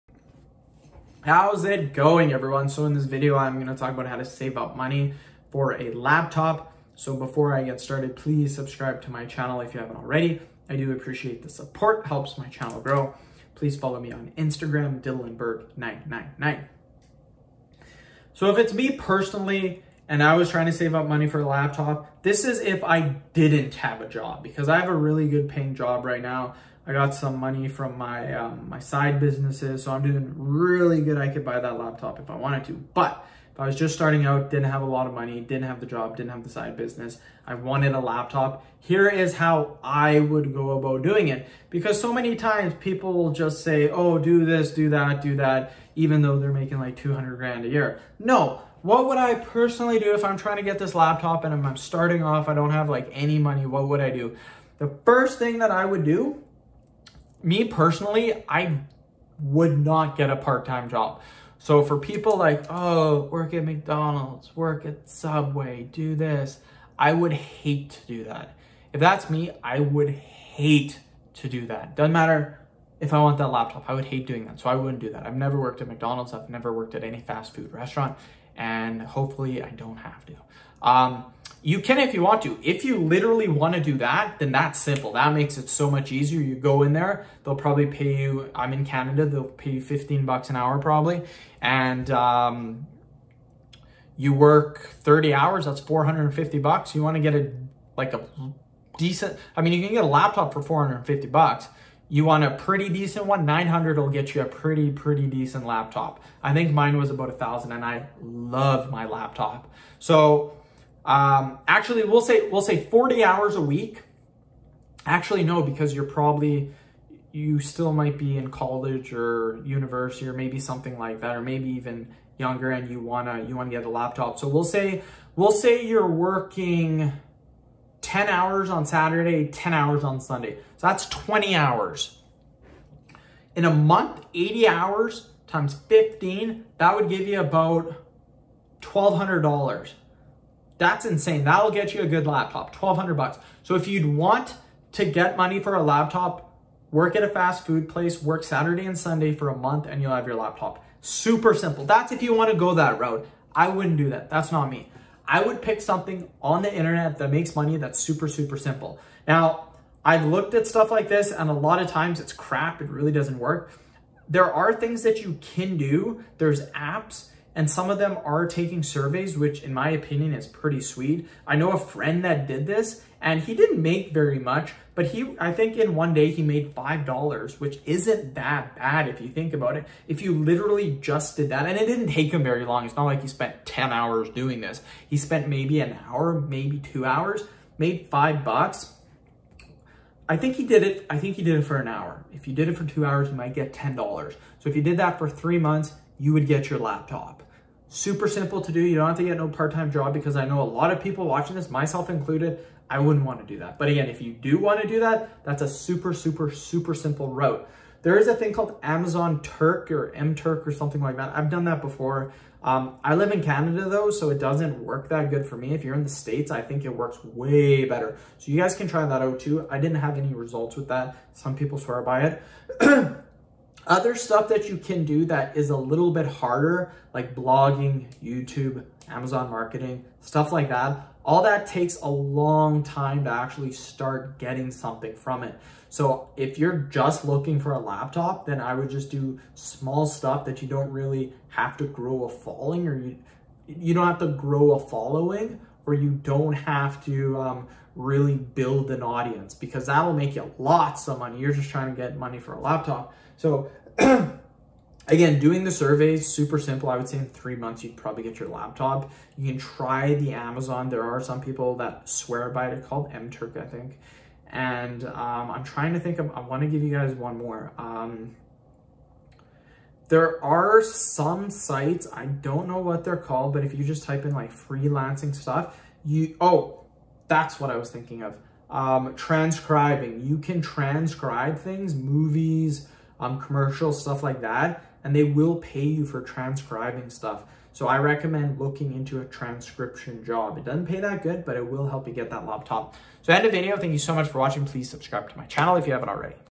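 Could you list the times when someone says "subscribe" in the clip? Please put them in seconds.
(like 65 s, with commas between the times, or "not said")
8 s, 294 s.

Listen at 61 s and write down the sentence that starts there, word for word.
So for people like, oh, work at McDonald's, work at Subway, do this, I would hate to do that.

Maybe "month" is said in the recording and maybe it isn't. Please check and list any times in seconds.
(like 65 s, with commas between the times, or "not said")
133 s, 149 s, 195 s, 257 s.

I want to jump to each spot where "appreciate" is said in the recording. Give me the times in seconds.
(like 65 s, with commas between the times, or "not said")
10 s.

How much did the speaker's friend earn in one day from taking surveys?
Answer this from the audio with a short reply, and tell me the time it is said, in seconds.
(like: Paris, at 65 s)
$5, at 176 s.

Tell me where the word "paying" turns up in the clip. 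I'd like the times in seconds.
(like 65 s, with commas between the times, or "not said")
25 s.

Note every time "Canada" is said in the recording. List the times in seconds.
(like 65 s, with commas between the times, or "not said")
88 s, 213 s.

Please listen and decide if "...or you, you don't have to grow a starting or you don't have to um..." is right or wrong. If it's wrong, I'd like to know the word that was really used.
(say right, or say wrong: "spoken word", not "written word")
wrong: "following", not "starting".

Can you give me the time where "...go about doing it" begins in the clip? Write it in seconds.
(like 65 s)
40 s.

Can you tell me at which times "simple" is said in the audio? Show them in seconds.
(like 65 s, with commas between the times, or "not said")
84 s, 151 s, 158 s, 198 s, 206 s, 256 s.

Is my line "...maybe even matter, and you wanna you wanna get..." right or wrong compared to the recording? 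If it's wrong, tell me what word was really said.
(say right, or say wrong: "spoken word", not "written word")
wrong: "younger", not "matter".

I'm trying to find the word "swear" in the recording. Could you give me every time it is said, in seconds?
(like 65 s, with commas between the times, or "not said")
221 s, 262 s.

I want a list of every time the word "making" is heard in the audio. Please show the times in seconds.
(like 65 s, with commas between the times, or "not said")
46 s.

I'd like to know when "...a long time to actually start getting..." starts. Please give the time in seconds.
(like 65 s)
232 s.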